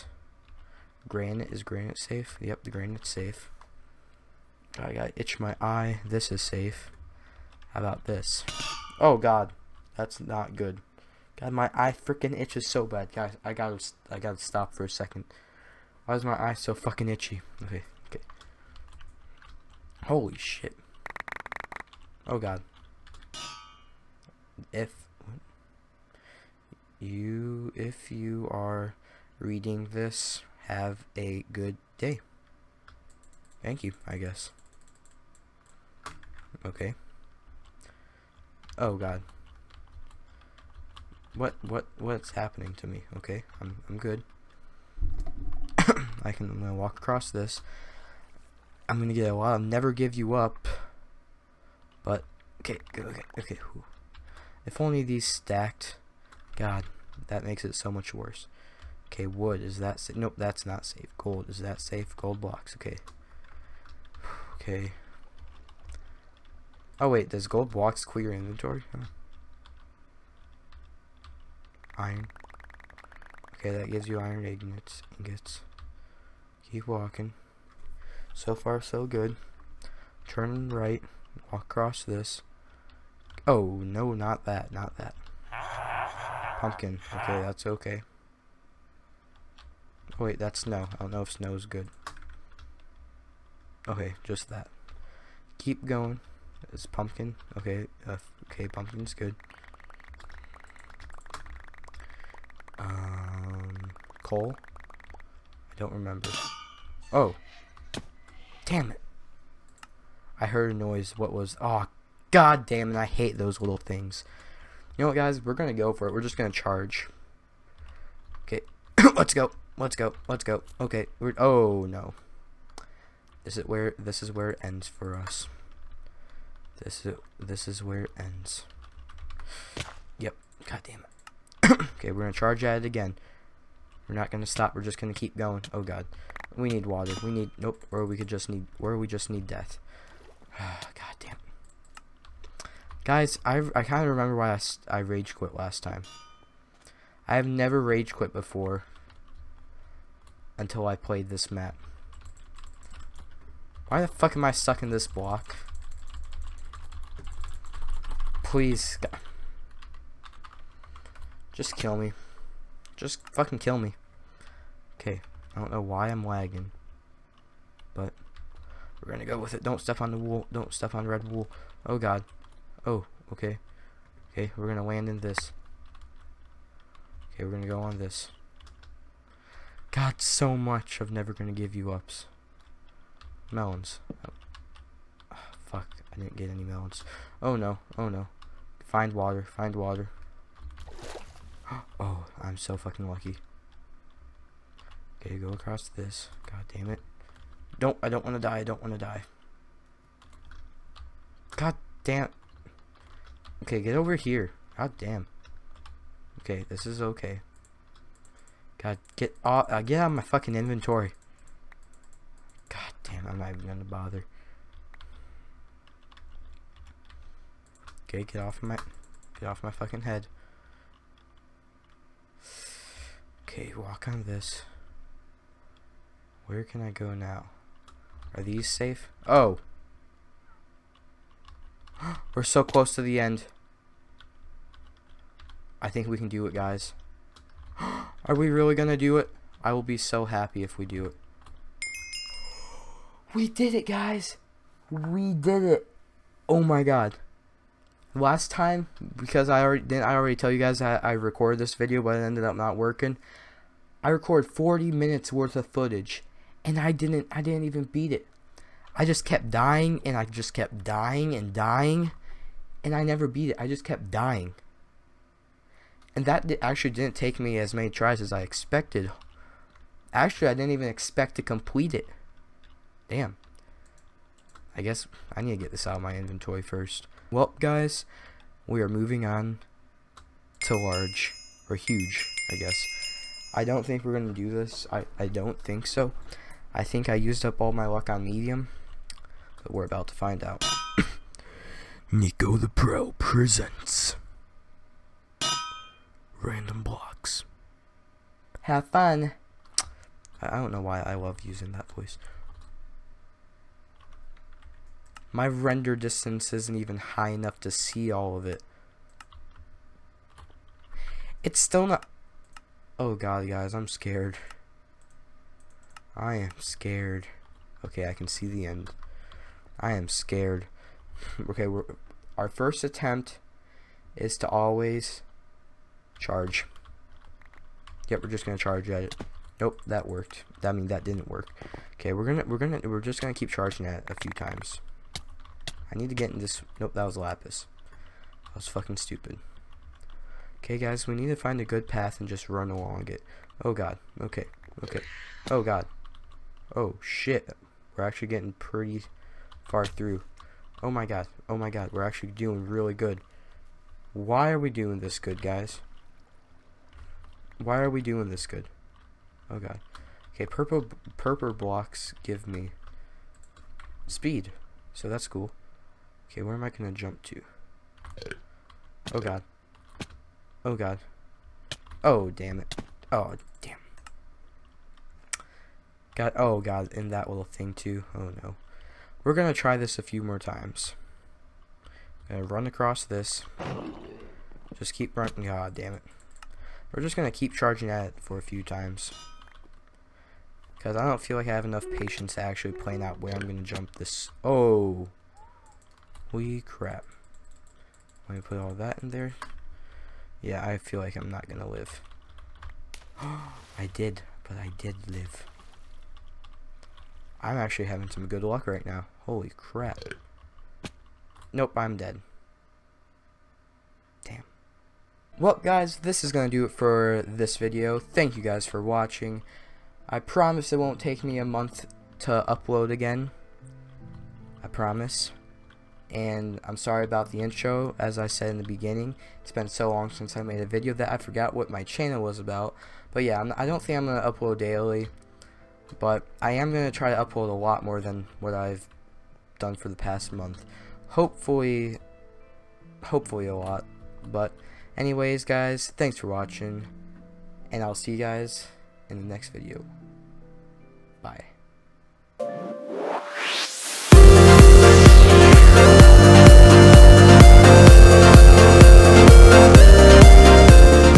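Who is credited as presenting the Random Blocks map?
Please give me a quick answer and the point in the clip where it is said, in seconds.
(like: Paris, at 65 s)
Nico the Pro, at 292 s.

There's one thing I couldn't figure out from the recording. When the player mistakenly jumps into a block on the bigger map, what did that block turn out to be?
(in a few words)
Lapis.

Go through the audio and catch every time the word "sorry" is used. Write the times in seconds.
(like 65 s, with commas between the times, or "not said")
426 s.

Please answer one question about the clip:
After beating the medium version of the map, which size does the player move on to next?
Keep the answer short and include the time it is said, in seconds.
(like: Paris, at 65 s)
Huge, at 281 s.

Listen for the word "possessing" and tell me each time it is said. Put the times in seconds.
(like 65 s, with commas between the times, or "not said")
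not said.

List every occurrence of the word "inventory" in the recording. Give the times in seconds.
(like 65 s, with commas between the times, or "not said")
68 s, 210 s, 276 s.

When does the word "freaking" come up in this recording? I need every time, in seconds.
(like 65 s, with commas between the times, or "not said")
11 s.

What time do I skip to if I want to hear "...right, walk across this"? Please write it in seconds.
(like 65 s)
80 s.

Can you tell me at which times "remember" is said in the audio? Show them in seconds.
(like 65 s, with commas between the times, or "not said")
105 s, 144 s.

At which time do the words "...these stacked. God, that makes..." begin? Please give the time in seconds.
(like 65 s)
55 s.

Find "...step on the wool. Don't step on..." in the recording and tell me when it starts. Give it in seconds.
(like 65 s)
169 s.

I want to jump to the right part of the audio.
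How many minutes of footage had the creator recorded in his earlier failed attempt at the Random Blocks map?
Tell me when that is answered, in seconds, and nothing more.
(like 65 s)
254 s.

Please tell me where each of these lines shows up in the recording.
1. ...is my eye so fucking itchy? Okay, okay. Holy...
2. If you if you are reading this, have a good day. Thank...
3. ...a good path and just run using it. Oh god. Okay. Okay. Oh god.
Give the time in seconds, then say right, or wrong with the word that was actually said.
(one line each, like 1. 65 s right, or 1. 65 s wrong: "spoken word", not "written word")
1. 16 s right
2. 24 s right
3. 341 s wrong: "along", not "using".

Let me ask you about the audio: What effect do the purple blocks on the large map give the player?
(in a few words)
Speed.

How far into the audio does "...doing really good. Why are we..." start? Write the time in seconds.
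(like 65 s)
352 s.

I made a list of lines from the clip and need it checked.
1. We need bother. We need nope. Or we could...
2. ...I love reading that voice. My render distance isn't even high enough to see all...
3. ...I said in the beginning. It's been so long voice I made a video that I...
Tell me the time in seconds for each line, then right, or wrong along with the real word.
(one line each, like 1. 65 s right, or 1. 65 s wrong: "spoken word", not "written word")
1. 136 s wrong: "water", not "bother"
2. 301 s wrong: "using", not "reading"
3. 428 s wrong: "since", not "voice".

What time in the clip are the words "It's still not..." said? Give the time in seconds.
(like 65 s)
311 s.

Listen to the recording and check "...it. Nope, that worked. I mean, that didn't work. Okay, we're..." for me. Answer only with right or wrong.
right.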